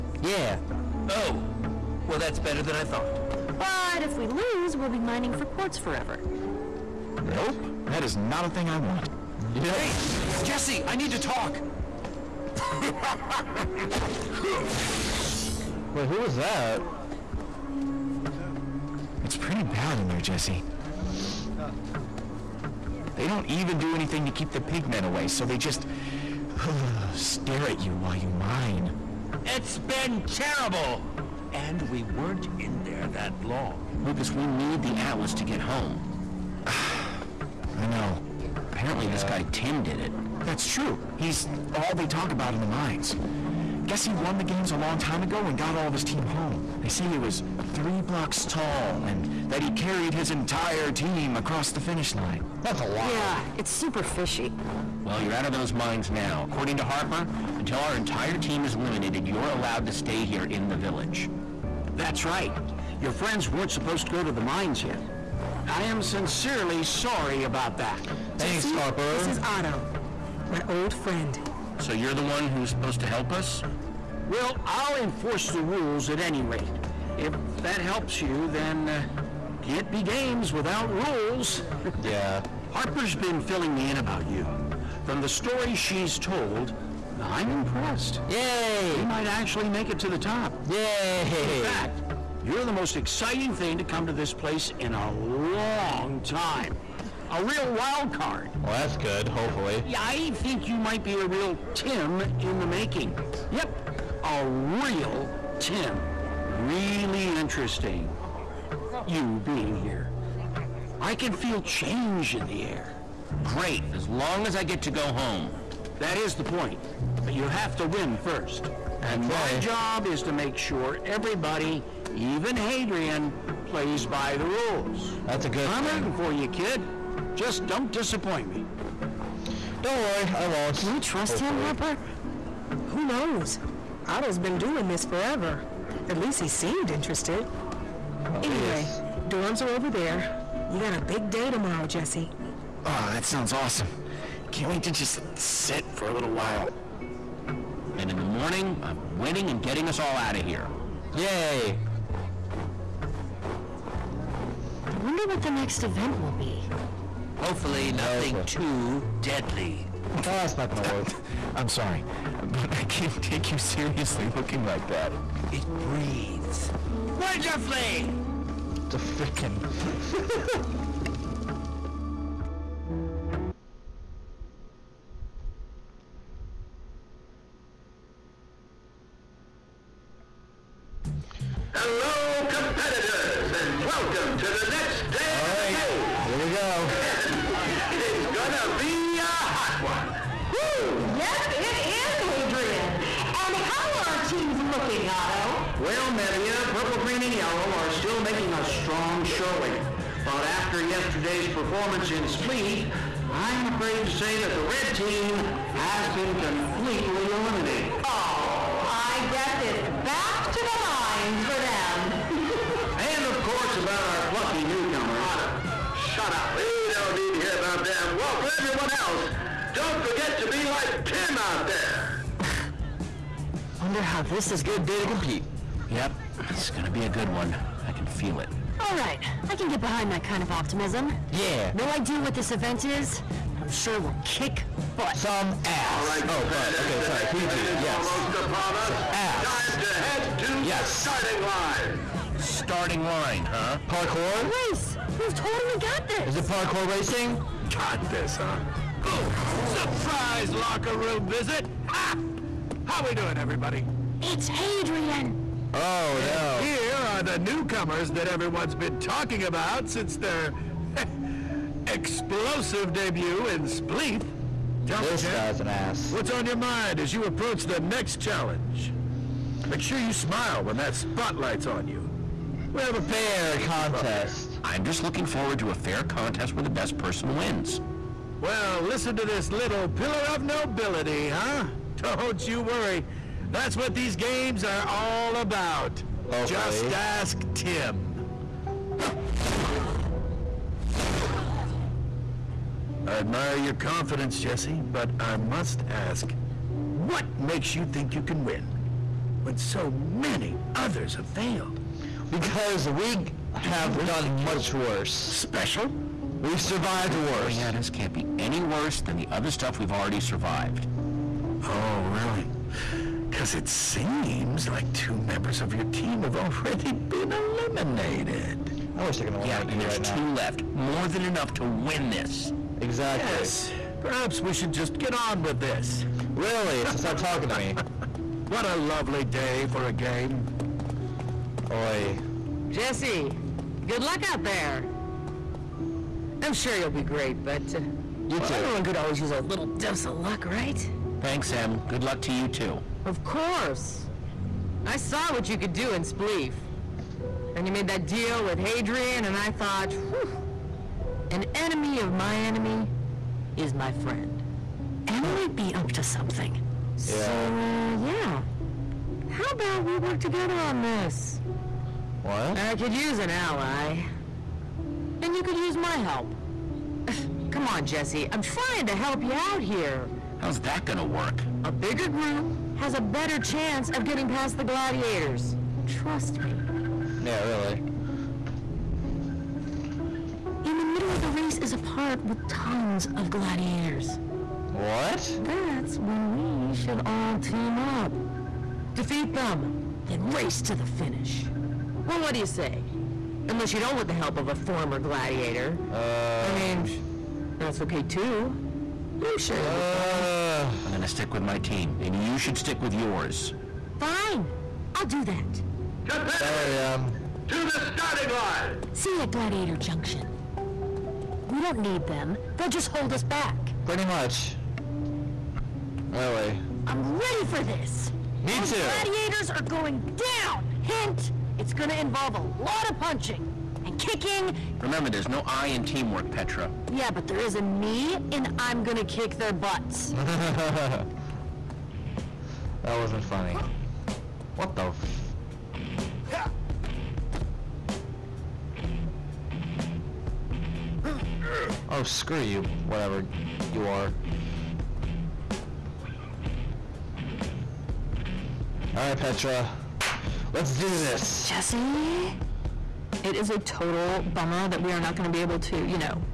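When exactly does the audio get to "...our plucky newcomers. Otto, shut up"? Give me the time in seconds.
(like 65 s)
214 s.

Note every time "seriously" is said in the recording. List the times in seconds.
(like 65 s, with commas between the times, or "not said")
163 s.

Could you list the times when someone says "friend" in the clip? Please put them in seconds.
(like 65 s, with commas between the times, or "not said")
63 s, 70 s, 353 s.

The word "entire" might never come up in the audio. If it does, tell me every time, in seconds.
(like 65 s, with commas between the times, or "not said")
50 s, 57 s.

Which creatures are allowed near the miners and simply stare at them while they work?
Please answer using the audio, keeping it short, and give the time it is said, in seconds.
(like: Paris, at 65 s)
Pigmen, at 24 s.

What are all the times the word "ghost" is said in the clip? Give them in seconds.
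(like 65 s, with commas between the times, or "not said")
not said.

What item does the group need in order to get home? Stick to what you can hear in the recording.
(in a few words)
The Atlas.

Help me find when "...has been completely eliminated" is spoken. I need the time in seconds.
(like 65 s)
205 s.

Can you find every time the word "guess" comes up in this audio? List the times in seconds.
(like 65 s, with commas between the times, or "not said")
43 s, 209 s.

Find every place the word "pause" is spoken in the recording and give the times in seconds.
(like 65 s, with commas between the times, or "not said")
not said.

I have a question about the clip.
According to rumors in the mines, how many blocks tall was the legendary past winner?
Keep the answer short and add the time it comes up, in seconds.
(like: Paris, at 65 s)
3, at 47 s.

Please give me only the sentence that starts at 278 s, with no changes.
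Well, listen to this little pillar of nobility, huh?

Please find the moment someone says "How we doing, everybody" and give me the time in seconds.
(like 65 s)
252 s.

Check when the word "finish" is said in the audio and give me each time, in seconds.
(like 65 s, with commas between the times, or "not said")
51 s, 390 s.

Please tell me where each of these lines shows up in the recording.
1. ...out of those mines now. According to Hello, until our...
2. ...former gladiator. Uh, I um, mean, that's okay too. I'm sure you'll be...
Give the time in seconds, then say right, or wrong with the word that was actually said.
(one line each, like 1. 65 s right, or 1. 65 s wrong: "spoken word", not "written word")
1. 55 s wrong: "Harper", not "Hello"
2. 394 s right.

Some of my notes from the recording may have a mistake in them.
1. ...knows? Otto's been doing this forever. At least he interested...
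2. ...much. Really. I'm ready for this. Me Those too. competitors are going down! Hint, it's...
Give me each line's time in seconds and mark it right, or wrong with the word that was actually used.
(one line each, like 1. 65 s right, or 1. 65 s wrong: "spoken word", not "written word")
1. 133 s wrong: "seemed", not "interested"
2. 414 s wrong: "gladiators", not "competitors".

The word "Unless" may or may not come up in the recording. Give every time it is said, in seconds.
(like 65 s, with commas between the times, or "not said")
393 s.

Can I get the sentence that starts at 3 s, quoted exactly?
But if we lose, we'll be mining for quartz forever.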